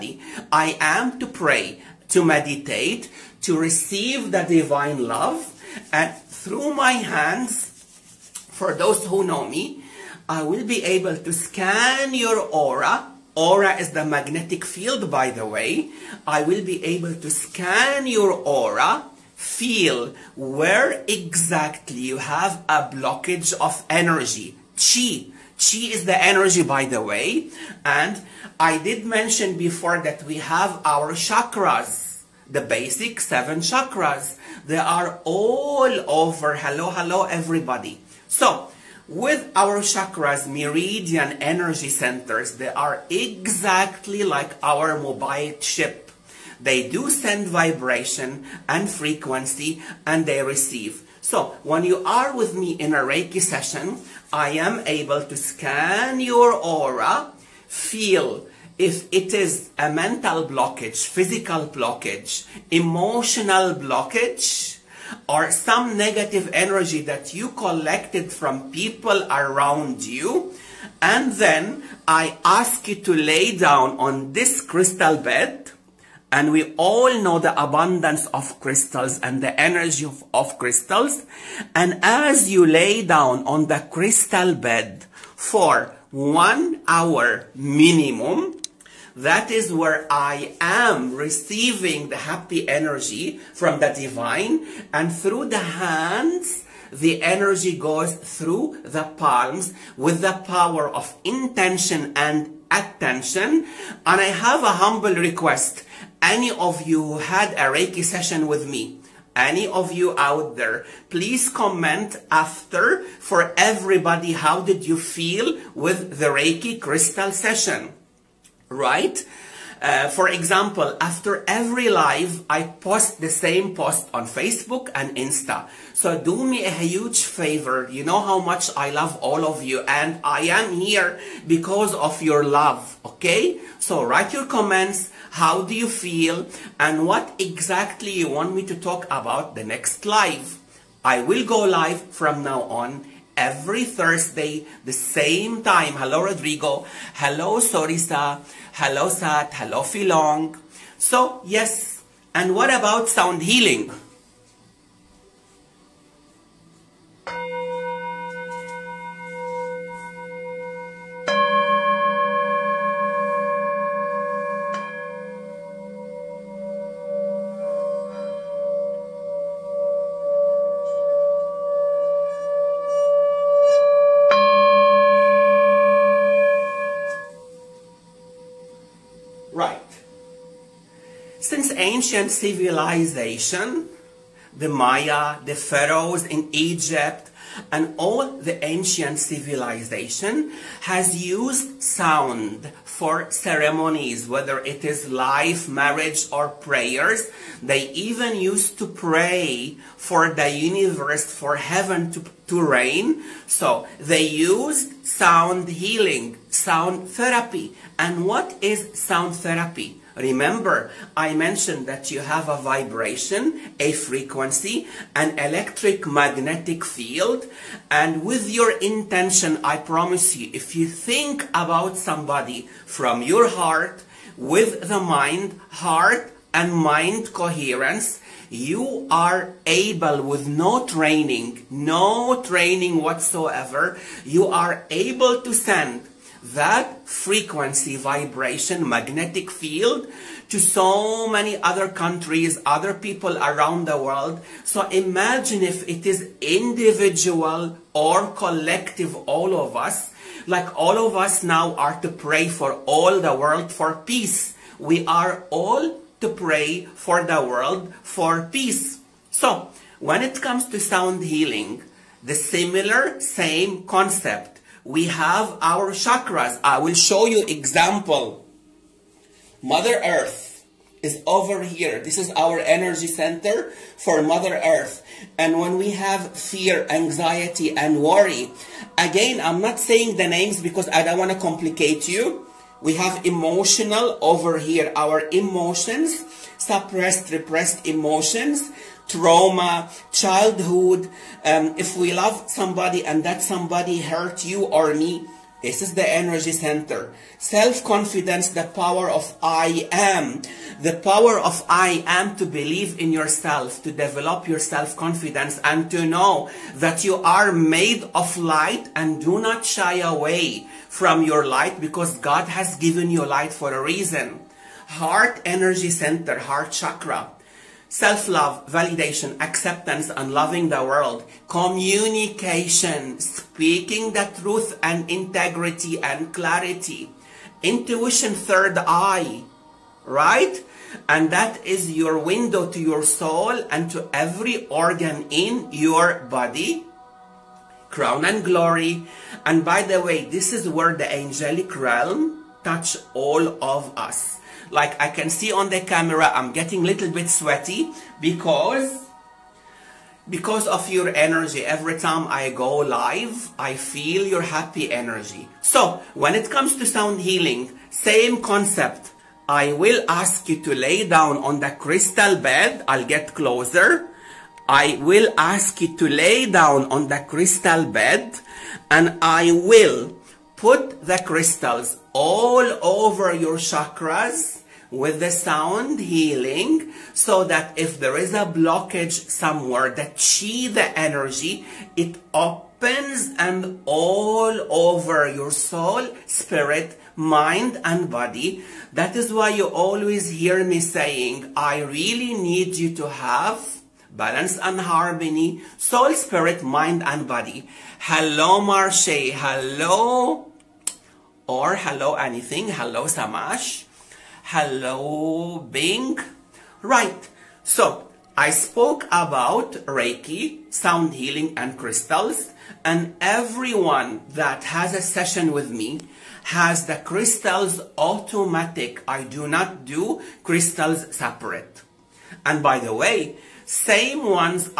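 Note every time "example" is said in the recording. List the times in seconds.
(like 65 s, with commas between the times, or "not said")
120 s, 267 s.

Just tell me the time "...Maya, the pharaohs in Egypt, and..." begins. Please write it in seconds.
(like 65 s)
184 s.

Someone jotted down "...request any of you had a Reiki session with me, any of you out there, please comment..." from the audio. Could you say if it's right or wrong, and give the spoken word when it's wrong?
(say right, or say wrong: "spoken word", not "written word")
right.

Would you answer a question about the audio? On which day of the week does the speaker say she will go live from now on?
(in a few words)
Thursday.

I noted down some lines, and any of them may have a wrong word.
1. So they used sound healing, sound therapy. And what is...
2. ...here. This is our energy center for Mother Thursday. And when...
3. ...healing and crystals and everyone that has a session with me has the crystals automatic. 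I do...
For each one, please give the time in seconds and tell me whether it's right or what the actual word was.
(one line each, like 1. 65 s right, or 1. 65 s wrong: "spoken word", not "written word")
1. 203 s right
2. 271 s wrong: "Earth", not "Thursday"
3. 411 s right.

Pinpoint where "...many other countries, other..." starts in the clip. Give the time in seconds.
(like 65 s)
241 s.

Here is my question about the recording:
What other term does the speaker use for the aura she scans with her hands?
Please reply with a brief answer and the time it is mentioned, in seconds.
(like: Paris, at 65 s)
the magnetic field, at 13 s.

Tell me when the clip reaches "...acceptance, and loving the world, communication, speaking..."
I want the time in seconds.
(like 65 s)
319 s.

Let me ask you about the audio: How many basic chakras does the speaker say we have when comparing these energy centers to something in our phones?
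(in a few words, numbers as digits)
7.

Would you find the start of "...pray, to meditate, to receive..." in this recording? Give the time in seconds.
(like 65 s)
1 s.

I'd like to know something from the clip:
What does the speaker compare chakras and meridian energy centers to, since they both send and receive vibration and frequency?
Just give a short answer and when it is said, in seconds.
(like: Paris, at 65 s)
mobile chip, at 44 s.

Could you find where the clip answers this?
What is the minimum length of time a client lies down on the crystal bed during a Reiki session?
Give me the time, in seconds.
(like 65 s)
86 s.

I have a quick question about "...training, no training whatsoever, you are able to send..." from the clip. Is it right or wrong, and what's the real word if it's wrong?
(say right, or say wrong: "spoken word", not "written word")
right.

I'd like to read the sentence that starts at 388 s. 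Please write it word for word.
That is why you always hear me saying, I really need you to have balance and harmony, soul, spirit, mind and body.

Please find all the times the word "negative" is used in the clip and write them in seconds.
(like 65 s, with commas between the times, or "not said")
65 s.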